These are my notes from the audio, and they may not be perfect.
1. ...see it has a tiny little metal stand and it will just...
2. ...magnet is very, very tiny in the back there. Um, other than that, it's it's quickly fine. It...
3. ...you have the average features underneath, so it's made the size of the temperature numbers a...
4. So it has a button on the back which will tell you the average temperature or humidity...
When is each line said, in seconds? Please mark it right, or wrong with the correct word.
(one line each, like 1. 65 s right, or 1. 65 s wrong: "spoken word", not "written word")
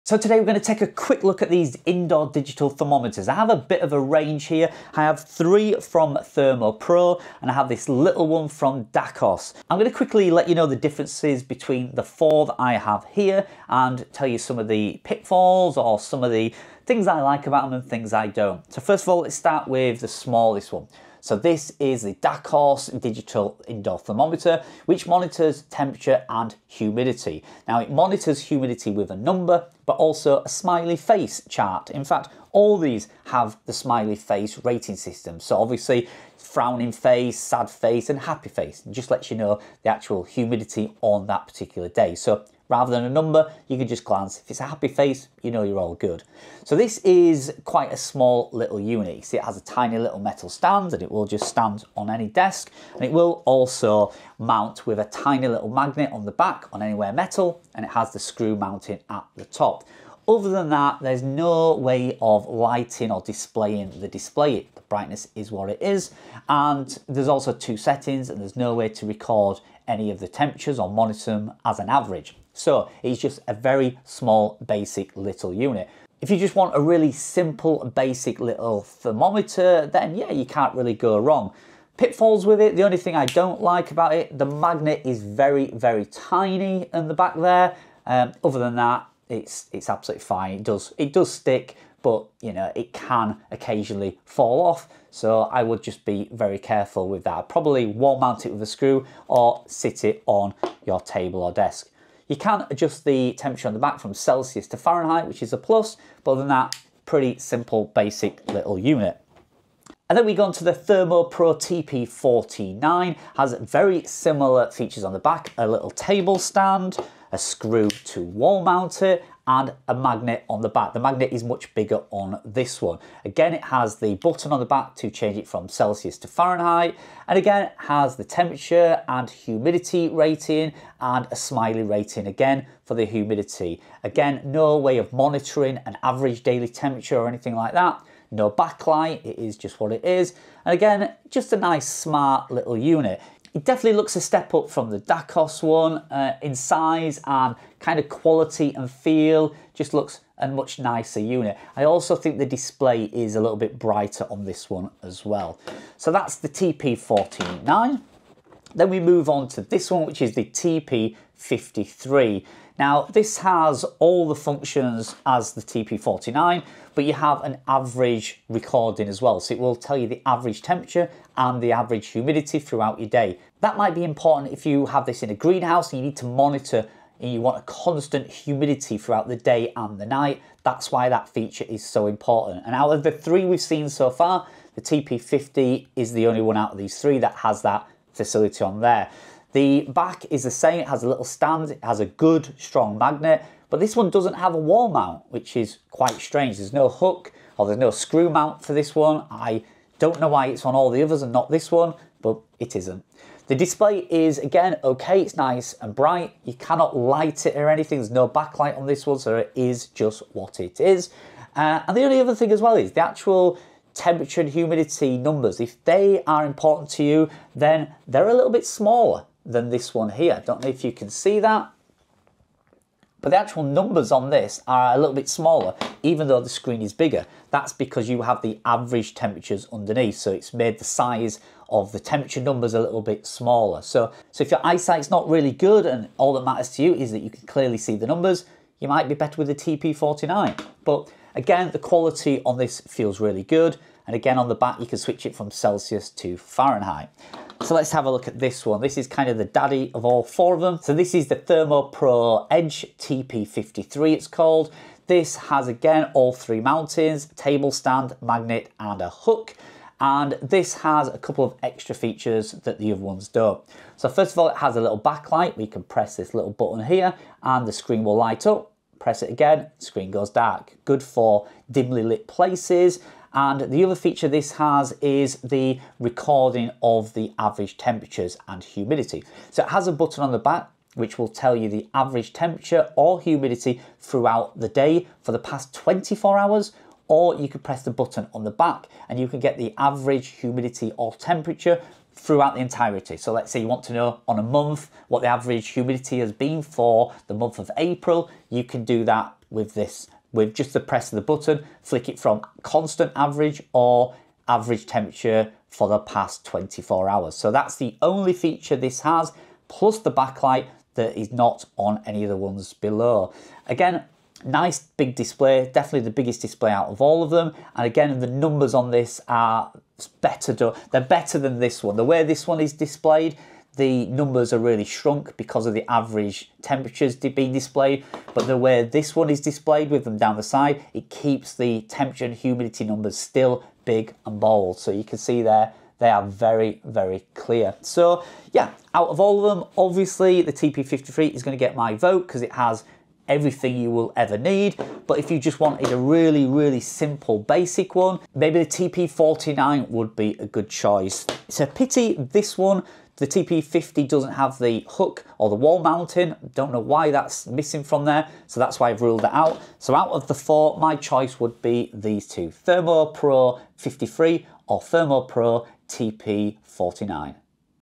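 1. 49 s right
2. 84 s wrong: "absolutely", not "quickly"
3. 228 s wrong: "temperatures", not "features"
4. 279 s right.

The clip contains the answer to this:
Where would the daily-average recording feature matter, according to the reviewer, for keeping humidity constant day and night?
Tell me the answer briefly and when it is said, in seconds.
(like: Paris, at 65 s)
a greenhouse, at 175 s.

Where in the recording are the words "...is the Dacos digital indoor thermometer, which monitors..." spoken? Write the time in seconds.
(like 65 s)
21 s.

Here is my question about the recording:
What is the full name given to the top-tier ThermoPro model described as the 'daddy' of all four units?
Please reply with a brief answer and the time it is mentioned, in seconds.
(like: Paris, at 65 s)
ThermoPro Edge TP53, at 251 s.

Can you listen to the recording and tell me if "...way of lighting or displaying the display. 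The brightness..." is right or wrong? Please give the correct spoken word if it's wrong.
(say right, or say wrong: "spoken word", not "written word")
right.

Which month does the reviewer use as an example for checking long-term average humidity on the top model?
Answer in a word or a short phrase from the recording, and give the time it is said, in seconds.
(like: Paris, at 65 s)
April, at 297 s.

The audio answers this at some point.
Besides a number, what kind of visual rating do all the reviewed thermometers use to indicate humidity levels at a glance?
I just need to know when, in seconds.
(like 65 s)
30 s.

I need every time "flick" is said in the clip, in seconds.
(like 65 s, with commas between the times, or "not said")
301 s.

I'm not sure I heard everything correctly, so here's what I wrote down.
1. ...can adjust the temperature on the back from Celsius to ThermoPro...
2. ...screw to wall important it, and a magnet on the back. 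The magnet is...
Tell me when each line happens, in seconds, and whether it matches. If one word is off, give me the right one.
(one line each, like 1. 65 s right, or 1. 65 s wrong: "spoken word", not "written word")
1. 102 s wrong: "Fahrenheit", not "ThermoPro"
2. 117 s wrong: "mount", not "important".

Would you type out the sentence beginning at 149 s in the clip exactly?
Just looks a much nicer unit.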